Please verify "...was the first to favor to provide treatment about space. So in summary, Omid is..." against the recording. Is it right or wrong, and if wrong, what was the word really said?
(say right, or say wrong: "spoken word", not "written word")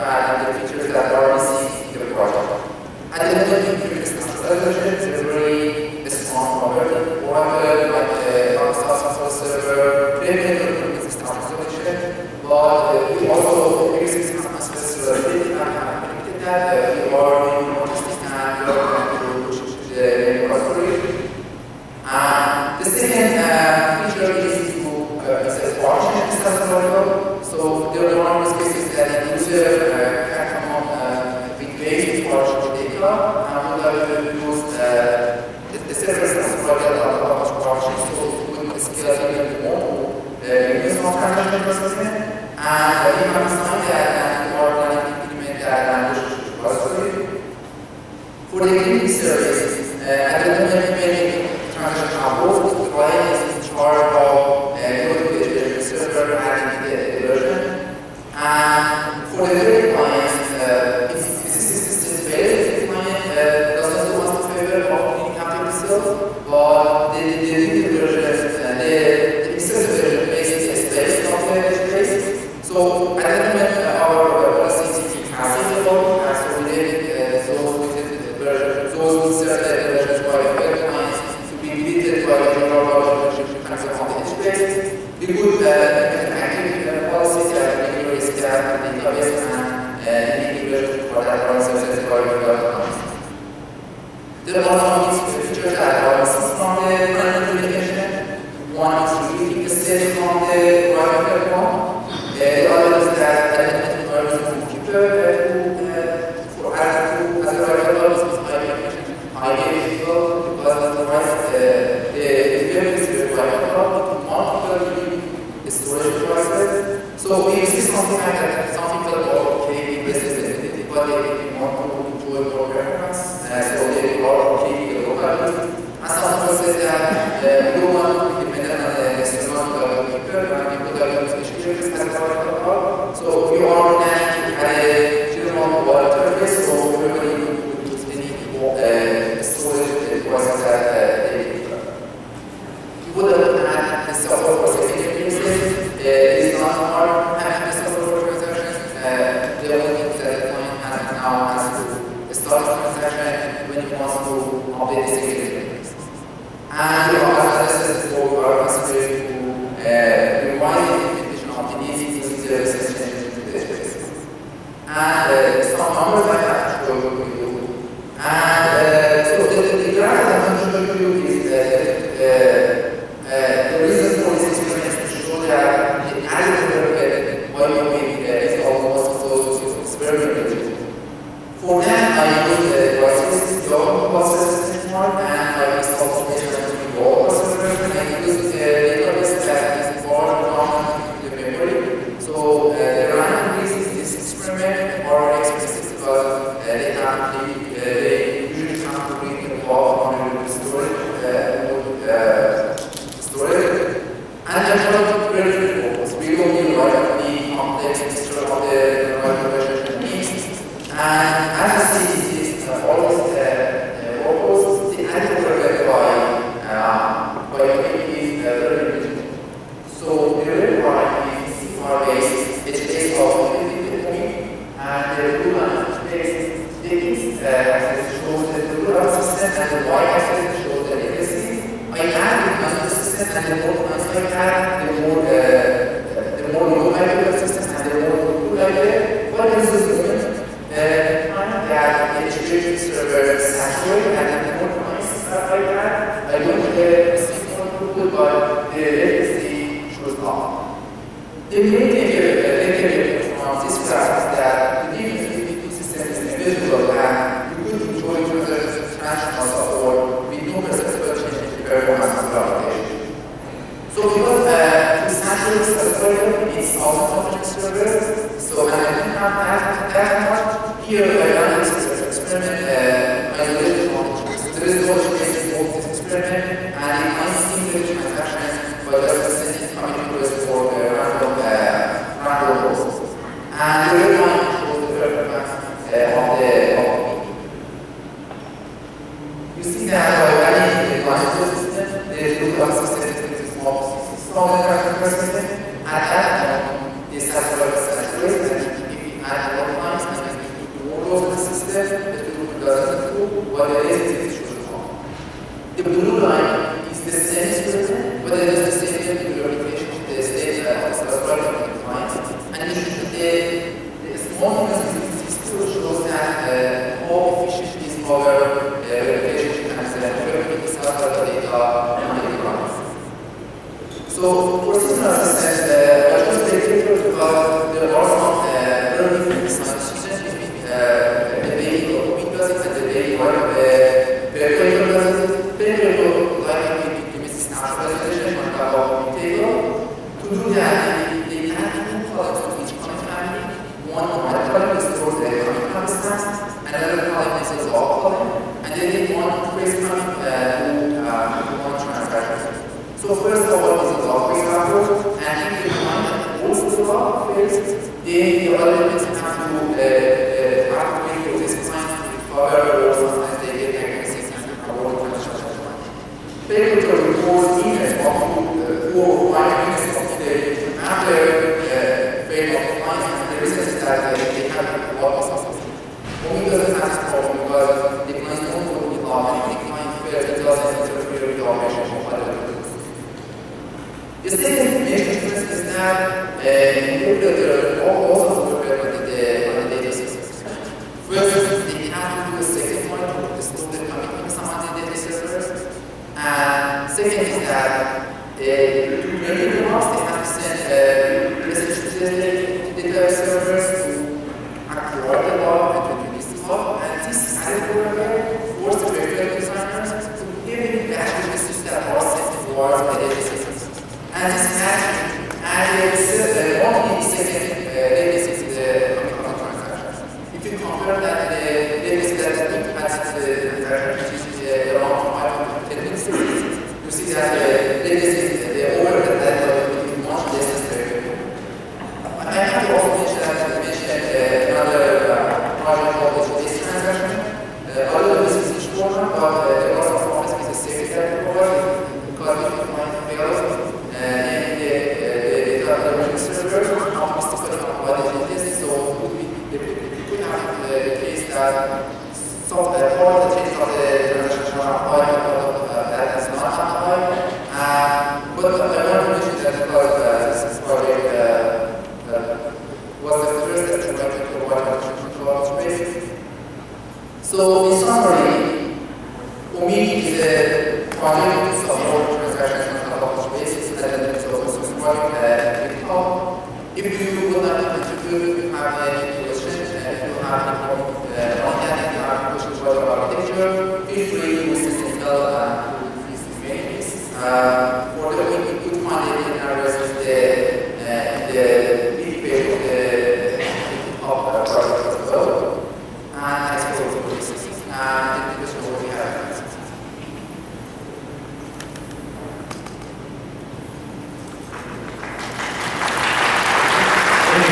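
wrong: "actuator", not "favor".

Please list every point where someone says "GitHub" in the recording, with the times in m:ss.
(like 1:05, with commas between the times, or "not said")
7:55, 8:13.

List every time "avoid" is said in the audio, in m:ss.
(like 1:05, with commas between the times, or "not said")
6:04, 7:27.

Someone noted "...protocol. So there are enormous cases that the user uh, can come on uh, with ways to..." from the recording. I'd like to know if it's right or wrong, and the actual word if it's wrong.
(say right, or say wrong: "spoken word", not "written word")
right.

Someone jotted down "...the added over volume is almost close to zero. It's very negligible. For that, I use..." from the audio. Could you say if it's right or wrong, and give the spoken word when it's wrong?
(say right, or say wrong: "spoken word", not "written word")
right.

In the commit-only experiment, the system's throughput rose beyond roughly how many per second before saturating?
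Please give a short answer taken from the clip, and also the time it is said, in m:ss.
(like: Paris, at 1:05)
60,000, at 4:53.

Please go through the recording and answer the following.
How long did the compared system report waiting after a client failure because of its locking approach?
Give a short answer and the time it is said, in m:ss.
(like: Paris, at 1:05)
4 or 5 minutes, at 6:08.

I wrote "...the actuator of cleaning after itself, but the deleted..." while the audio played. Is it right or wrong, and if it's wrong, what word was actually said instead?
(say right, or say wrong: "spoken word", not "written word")
wrong: "favor", not "actuator".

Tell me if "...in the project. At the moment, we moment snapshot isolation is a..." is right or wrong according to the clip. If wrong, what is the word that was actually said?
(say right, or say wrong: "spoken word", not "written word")
wrong: "implement", not "moment".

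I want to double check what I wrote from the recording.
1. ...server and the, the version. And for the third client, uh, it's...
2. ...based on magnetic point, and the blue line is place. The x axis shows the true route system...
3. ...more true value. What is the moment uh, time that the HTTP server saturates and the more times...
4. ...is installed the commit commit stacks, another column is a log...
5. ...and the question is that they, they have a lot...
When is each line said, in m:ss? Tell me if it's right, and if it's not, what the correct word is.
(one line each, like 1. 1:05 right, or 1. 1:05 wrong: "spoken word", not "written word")
1. 0:55 right
2. 3:42 right
3. 3:58 right
4. 5:44 wrong: "stored", not "installed"
5. 6:13 wrong: "reason", not "question".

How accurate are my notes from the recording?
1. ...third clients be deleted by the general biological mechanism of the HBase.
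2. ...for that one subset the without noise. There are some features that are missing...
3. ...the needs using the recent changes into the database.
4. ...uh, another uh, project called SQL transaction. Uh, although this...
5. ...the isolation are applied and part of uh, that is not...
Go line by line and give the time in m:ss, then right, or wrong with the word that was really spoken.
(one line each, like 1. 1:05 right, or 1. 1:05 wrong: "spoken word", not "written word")
1. 1:20 right
2. 1:31 right
3. 2:41 right
4. 7:13 wrong: "HBase", not "SQL"
5. 7:33 wrong: "transaction", not "isolation".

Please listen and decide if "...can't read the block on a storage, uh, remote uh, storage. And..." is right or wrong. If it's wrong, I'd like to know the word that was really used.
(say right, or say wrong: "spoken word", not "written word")
right.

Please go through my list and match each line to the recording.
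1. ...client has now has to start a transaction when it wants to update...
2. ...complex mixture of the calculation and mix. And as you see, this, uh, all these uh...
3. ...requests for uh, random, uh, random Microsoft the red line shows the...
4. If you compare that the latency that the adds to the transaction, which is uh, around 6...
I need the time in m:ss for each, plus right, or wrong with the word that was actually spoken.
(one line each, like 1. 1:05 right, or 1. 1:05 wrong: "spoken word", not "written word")
1. 2:30 right
2. 3:27 right
3. 4:40 wrong: "And", not "Microsoft"
4. 7:00 wrong: "5", not "6".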